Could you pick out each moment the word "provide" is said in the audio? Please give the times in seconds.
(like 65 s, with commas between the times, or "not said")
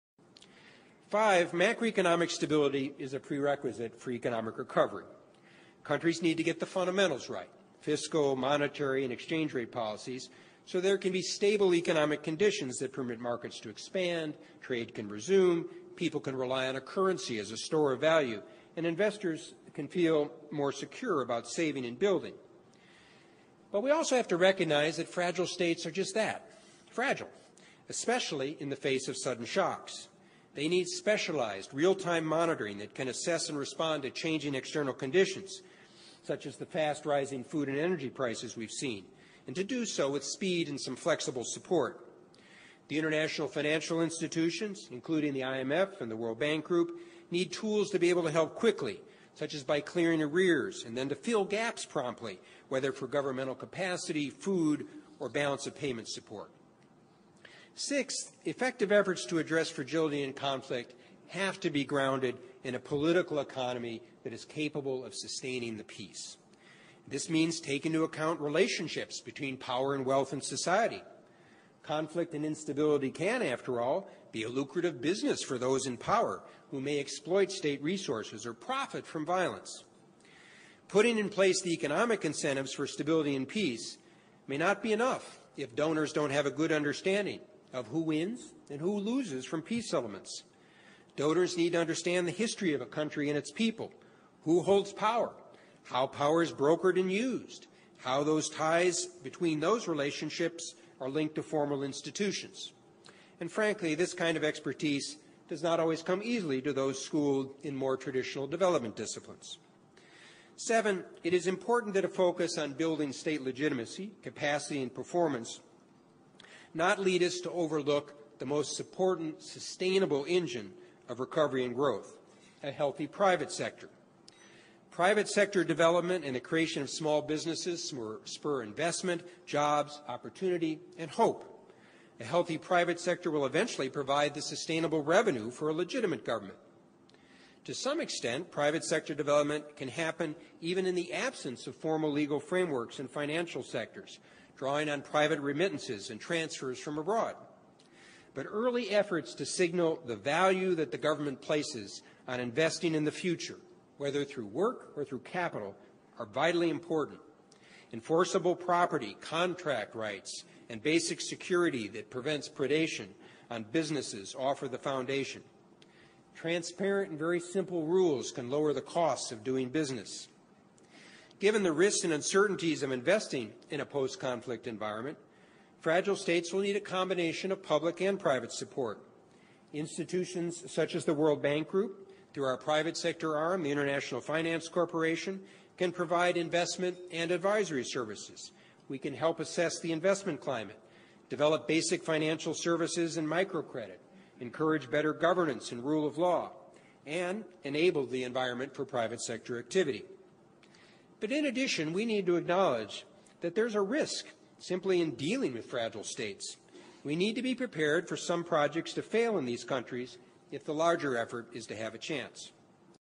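133 s, 185 s.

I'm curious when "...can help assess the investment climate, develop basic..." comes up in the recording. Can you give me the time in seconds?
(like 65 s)
188 s.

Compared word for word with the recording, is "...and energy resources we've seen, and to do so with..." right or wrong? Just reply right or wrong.
wrong.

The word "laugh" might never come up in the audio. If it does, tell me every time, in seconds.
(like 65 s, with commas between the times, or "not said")
not said.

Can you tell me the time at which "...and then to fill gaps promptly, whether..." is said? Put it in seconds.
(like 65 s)
50 s.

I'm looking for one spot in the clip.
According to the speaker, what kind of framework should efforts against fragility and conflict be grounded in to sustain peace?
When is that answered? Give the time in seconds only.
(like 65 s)
62 s.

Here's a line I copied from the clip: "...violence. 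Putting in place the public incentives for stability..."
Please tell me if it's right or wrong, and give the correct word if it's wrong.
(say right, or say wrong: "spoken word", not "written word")
wrong: "economic", not "public".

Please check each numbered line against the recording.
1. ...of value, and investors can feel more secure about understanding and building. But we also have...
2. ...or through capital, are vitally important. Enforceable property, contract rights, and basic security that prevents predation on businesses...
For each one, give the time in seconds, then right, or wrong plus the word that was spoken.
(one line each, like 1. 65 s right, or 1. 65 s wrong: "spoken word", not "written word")
1. 17 s wrong: "saving", not "understanding"
2. 154 s right.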